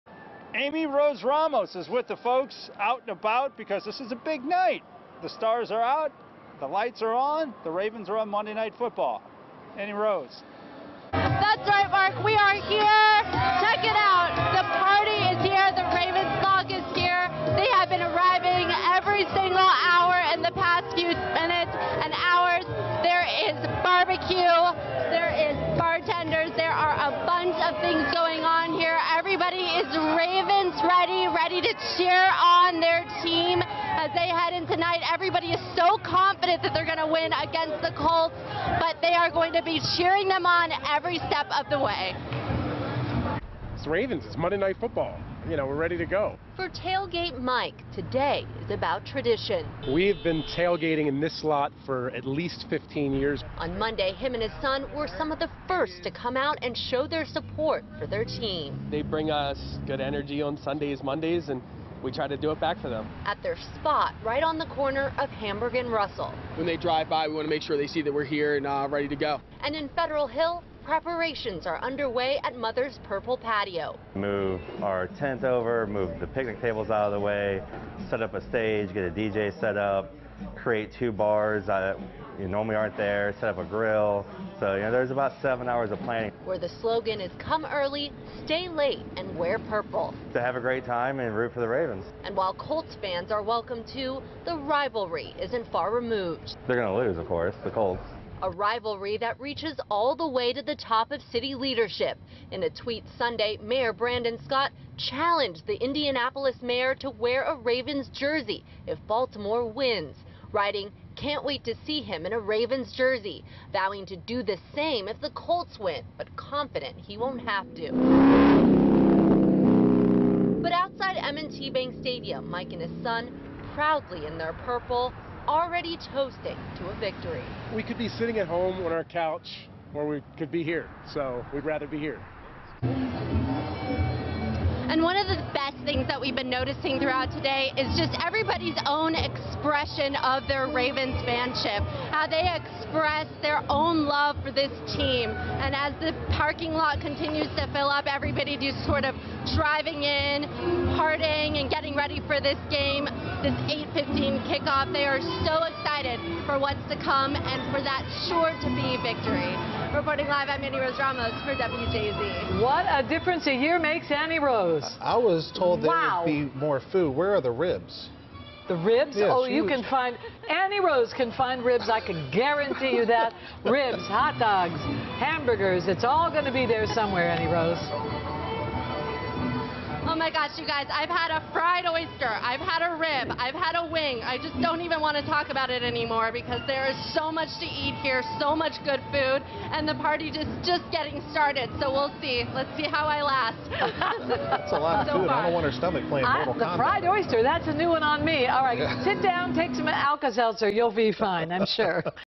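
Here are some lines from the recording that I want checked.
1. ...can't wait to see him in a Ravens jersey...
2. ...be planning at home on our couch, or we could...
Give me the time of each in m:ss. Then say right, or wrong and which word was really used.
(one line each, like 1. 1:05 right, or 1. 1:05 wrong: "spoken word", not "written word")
1. 1:51 right
2. 2:07 wrong: "sitting", not "planning".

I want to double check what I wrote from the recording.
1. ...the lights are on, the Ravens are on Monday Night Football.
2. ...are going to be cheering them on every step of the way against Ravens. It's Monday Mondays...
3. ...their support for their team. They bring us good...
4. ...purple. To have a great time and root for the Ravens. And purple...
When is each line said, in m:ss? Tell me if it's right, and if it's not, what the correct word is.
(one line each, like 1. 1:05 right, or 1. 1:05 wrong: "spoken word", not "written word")
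1. 0:06 right
2. 0:39 wrong: "Night", not "Mondays"
3. 0:57 right
4. 1:29 wrong: "while", not "purple".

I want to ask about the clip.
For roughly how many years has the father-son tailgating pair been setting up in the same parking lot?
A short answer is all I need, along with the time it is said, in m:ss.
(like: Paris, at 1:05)
15, at 0:52.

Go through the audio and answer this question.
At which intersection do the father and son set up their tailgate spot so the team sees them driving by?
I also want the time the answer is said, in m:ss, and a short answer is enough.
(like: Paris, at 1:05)
Hamburg and Russell, at 1:05.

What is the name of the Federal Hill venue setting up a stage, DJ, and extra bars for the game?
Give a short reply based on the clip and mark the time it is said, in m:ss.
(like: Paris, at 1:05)
Mother's Purple Patio, at 1:12.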